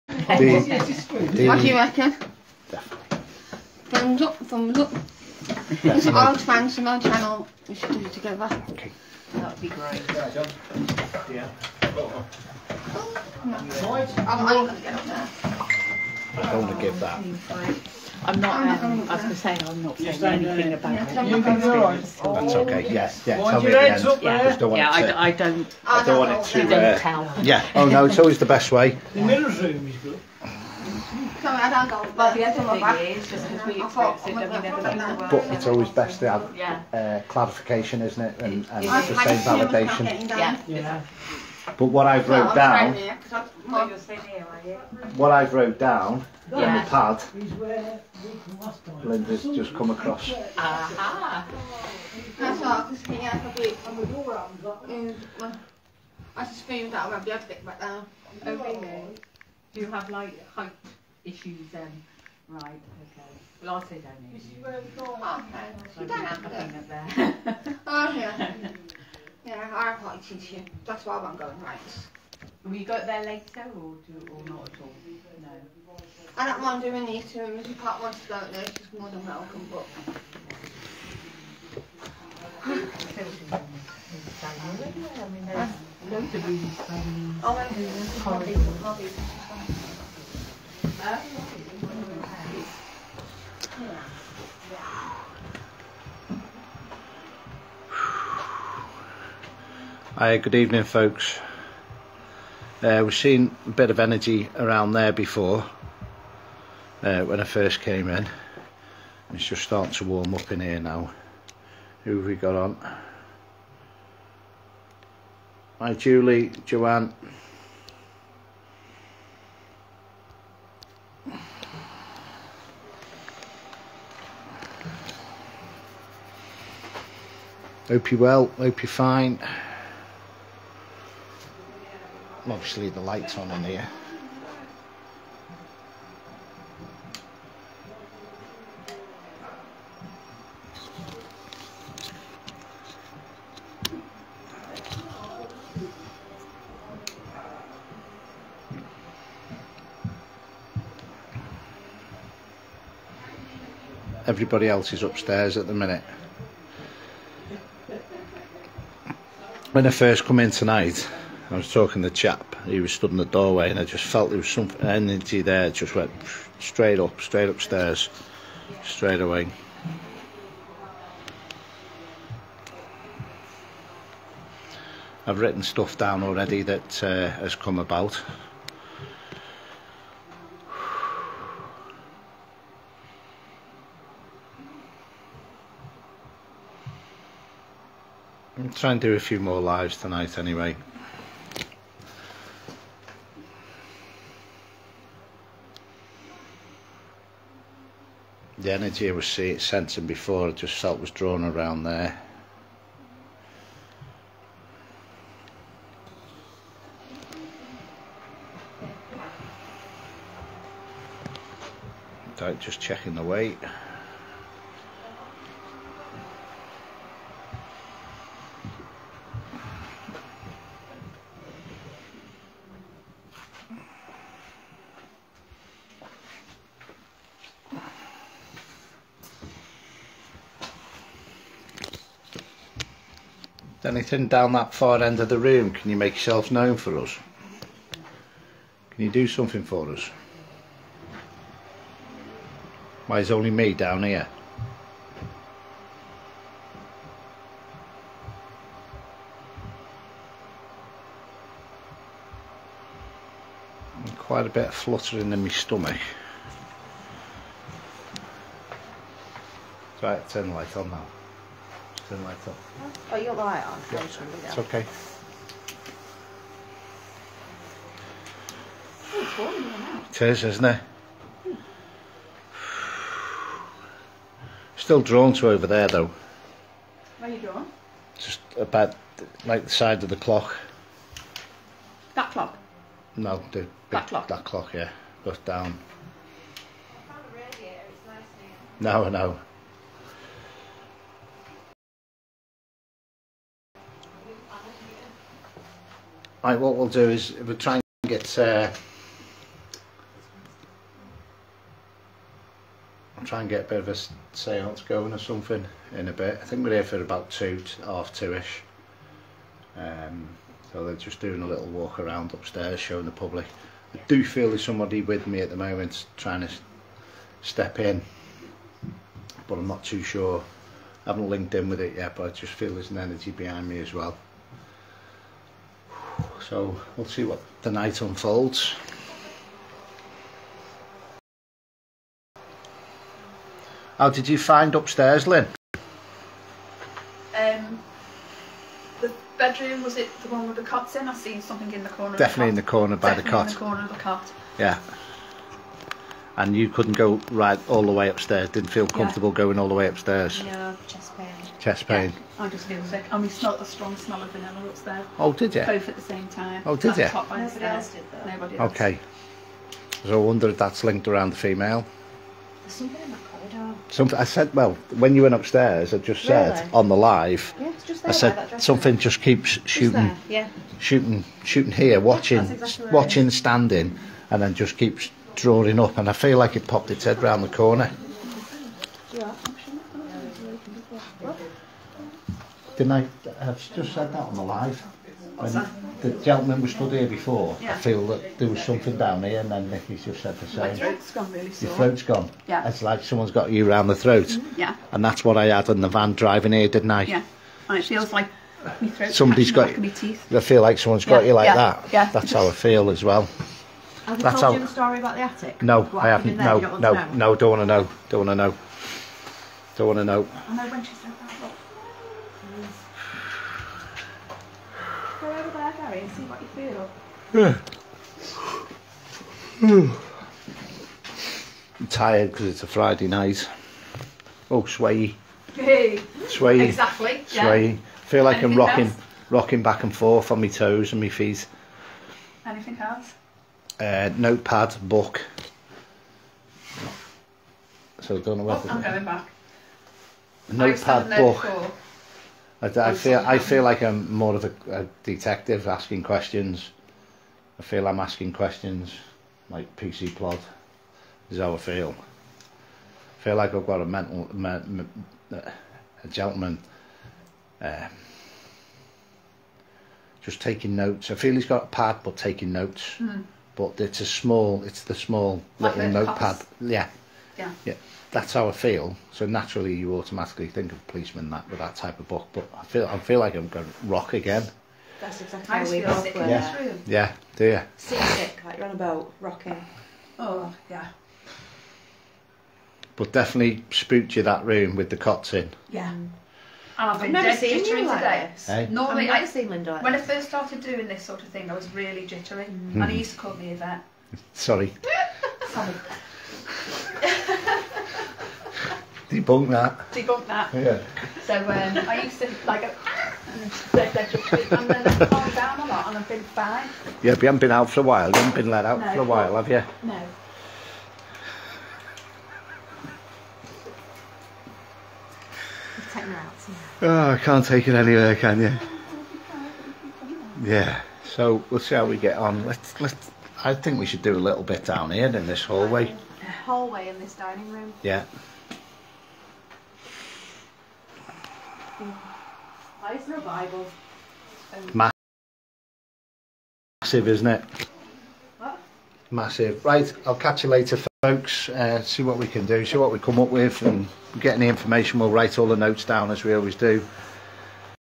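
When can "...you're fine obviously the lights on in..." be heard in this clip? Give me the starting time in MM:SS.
02:08.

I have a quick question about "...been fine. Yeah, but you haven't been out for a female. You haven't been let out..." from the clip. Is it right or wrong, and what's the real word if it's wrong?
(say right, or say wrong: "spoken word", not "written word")
wrong: "while", not "female".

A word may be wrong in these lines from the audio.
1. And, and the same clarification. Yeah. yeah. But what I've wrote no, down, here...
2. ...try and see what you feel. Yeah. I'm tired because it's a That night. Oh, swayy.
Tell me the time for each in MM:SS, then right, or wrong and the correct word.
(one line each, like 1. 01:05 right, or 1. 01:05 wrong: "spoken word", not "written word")
1. 00:38 wrong: "validation", not "clarification"
2. 06:55 wrong: "Friday", not "That".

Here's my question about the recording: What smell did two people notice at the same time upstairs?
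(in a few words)
Vanilla.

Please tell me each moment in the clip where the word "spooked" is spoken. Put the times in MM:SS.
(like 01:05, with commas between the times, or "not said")
08:03.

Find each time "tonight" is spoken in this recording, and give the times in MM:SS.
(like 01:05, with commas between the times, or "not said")
02:40, 03:09.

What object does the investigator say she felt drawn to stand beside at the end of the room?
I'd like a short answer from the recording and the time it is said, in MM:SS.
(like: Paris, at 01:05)
The clock, at 04:39.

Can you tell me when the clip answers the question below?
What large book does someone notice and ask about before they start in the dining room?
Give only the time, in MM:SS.
08:53.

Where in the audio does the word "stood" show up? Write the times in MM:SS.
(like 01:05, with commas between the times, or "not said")
02:42, 06:26.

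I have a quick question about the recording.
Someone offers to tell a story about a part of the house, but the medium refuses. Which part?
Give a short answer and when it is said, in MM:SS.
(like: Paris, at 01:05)
The attic, at 06:45.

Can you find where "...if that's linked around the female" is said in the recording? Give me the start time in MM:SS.
06:00.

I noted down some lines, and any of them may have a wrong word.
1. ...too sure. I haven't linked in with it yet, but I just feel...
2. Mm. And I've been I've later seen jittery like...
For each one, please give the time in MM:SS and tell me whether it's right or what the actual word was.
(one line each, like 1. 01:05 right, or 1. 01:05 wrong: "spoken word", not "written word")
1. 05:19 right
2. 08:05 wrong: "never", not "later".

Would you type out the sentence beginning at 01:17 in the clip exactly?
if Pat wants to go there, she's more than welcome.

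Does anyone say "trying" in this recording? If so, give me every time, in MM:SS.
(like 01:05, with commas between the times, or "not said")
03:08, 05:16.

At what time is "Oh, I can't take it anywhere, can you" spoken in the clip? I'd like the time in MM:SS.
08:36.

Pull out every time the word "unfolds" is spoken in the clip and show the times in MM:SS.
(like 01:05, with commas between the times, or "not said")
05:28.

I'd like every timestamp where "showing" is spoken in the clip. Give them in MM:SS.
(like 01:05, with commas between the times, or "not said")
05:12.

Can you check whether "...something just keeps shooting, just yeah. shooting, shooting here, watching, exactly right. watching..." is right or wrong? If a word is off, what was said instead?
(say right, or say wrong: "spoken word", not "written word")
right.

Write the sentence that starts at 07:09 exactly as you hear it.
rocking back and forth on my toes and my feet.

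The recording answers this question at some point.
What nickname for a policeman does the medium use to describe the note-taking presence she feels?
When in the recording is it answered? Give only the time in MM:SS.
07:29.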